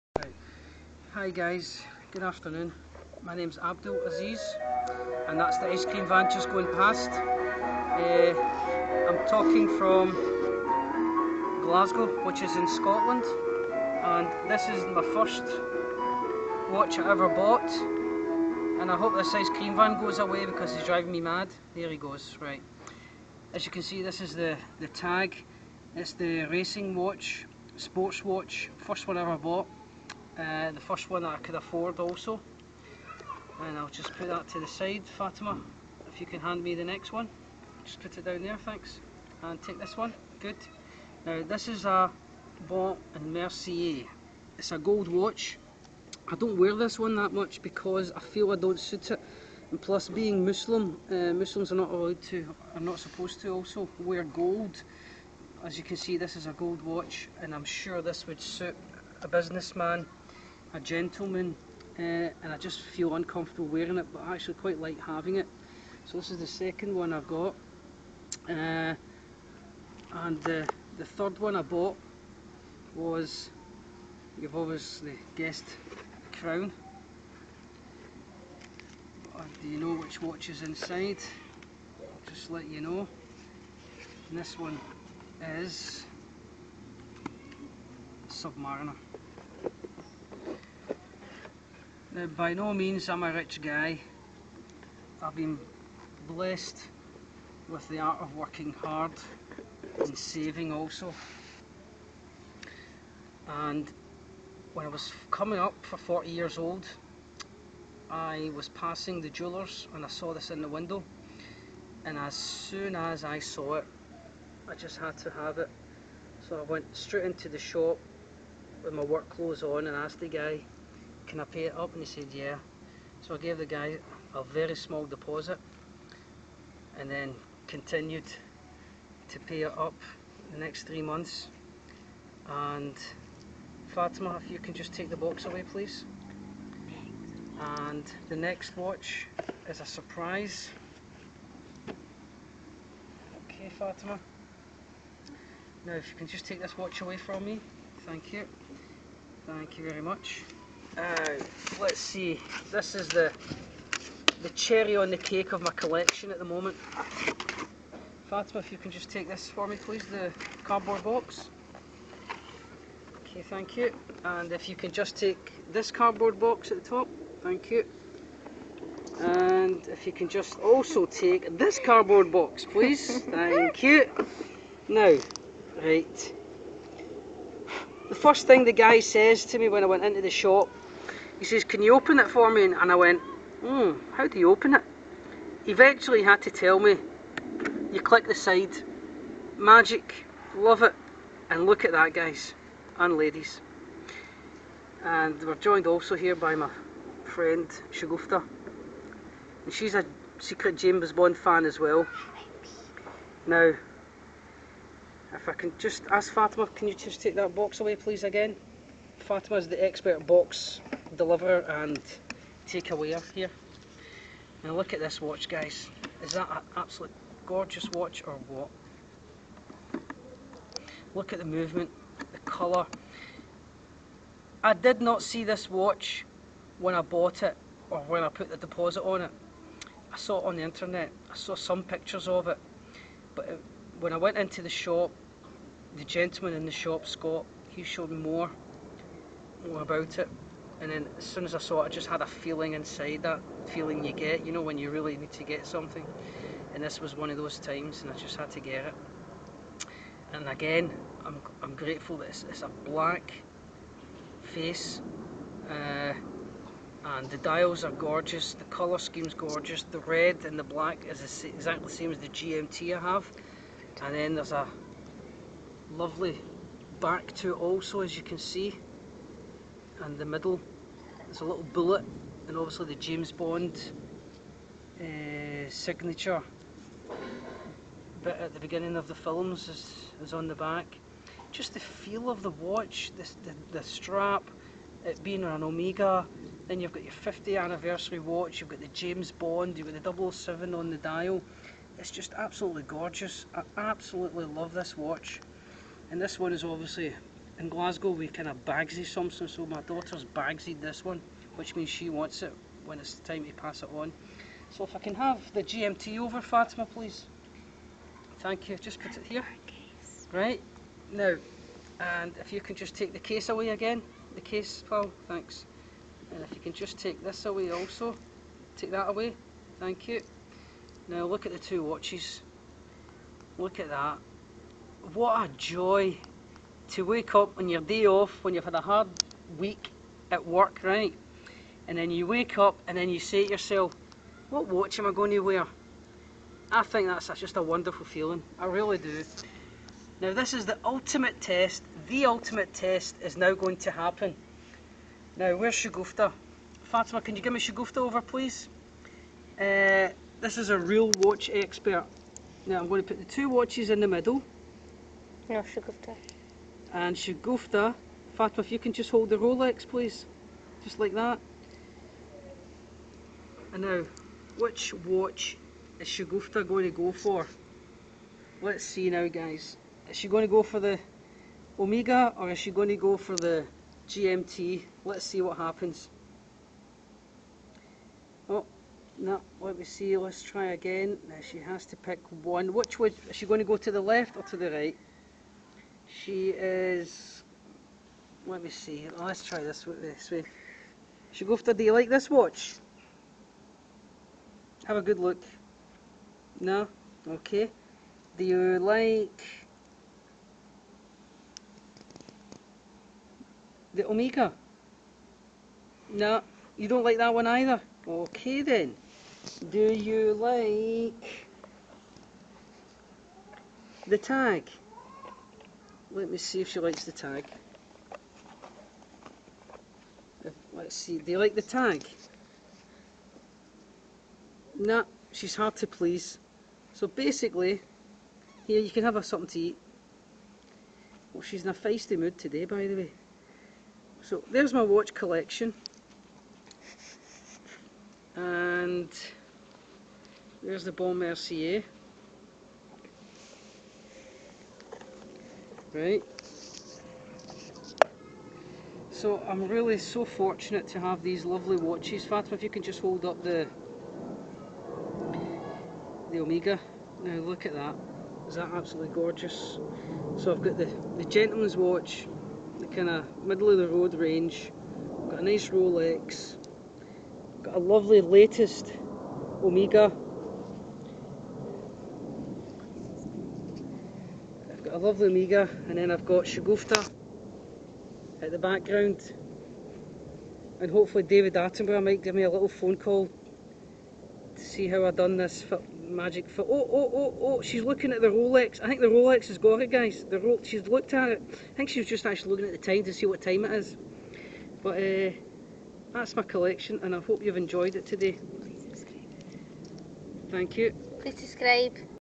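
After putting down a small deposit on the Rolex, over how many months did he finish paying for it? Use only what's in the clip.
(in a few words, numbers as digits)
3.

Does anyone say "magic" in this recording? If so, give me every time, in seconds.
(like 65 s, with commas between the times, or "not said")
189 s, 486 s.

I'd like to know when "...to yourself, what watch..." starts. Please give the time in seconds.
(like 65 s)
333 s.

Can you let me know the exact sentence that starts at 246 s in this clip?
And this was one of those times, and I just had to get it.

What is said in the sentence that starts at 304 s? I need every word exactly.
So if I can have the GMT over, Fatima, please.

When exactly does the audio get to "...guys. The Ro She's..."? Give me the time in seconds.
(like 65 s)
489 s.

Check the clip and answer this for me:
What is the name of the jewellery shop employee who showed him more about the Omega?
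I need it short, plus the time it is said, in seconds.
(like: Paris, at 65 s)
Scott, at 237 s.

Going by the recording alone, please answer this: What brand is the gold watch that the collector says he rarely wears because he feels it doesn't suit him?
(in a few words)
Baume and Mercier.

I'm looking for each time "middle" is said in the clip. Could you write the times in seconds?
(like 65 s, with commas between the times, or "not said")
270 s, 354 s, 463 s.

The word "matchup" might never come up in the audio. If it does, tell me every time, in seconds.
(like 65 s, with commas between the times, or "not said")
not said.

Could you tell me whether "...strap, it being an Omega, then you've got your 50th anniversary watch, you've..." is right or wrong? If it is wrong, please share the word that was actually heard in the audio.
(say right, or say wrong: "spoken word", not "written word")
right.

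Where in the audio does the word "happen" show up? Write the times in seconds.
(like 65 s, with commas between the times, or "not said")
343 s, 375 s.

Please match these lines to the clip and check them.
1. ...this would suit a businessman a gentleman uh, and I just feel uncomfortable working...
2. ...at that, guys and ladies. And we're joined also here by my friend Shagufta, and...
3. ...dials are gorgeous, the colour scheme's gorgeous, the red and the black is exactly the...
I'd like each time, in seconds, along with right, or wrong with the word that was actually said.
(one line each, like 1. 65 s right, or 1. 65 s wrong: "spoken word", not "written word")
1. 58 s wrong: "wearing", not "working"
2. 191 s right
3. 257 s right.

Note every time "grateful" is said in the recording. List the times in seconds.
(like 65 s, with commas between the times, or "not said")
251 s.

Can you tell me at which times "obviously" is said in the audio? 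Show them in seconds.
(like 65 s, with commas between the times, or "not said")
74 s, 272 s, 296 s.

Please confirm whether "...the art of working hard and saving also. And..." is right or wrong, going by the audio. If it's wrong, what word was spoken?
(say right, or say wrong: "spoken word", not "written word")
right.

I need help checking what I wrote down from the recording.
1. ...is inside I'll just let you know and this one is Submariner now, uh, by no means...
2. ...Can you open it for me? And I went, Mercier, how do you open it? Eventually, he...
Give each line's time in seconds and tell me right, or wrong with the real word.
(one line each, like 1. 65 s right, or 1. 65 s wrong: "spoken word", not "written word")
1. 80 s right
2. 181 s wrong: "Hmm", not "Mercier".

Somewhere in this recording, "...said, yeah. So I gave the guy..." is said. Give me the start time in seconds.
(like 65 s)
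122 s.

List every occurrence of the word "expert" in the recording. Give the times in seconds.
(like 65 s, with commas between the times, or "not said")
209 s, 351 s.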